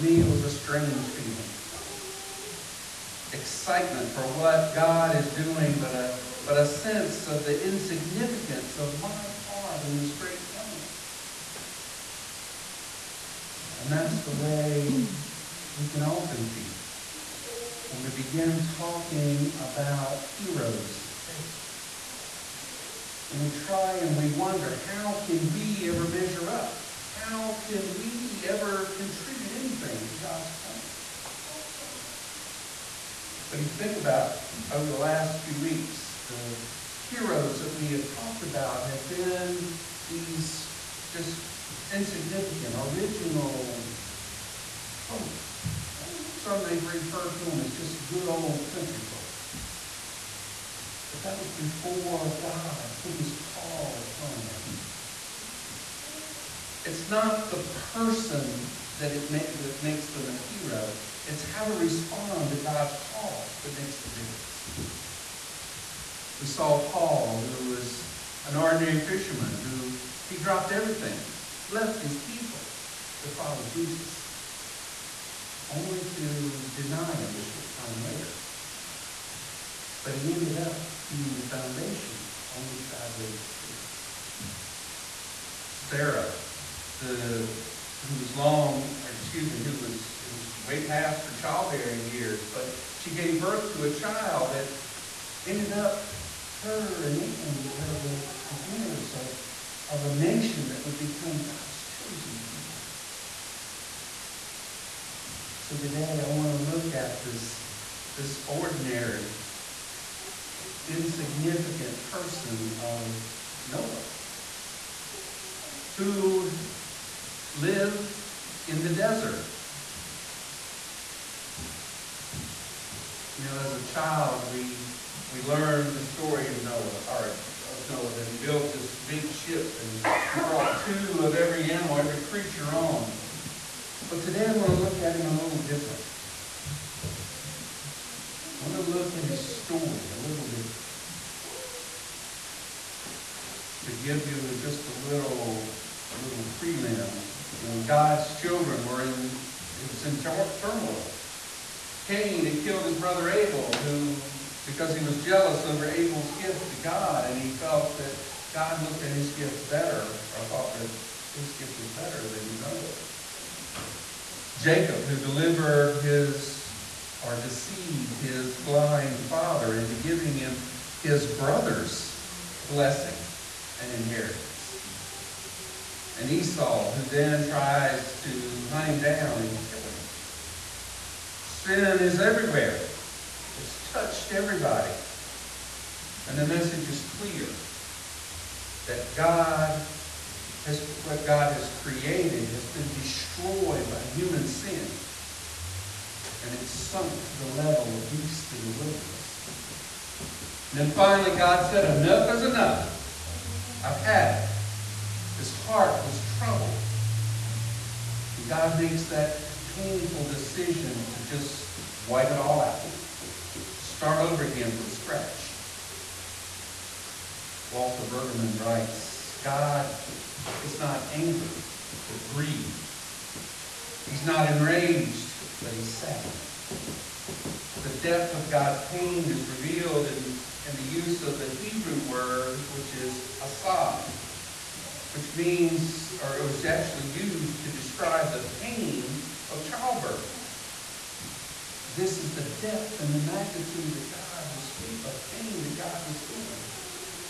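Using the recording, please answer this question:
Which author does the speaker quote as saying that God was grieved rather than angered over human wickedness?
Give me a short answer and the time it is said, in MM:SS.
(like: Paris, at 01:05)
Walter Brueggemann, at 03:37.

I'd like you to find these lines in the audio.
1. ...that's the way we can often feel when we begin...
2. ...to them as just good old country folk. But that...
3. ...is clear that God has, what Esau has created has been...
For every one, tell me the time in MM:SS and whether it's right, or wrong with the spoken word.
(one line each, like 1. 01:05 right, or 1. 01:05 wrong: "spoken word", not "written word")
1. 00:13 right
2. 00:47 right
3. 03:06 wrong: "God", not "Esau".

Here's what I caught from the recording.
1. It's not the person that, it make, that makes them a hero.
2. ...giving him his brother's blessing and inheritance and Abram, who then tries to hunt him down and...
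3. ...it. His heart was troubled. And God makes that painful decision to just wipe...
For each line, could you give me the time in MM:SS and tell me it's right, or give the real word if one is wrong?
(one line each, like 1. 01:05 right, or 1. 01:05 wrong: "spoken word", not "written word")
1. 00:56 right
2. 02:50 wrong: "Esau", not "Abram"
3. 03:24 right.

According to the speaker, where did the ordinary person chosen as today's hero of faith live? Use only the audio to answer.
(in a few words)
the desert.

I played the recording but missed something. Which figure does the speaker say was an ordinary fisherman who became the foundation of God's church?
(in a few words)
Paul.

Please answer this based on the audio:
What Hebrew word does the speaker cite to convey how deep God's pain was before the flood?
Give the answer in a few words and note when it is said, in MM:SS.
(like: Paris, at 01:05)
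asav, at 03:53.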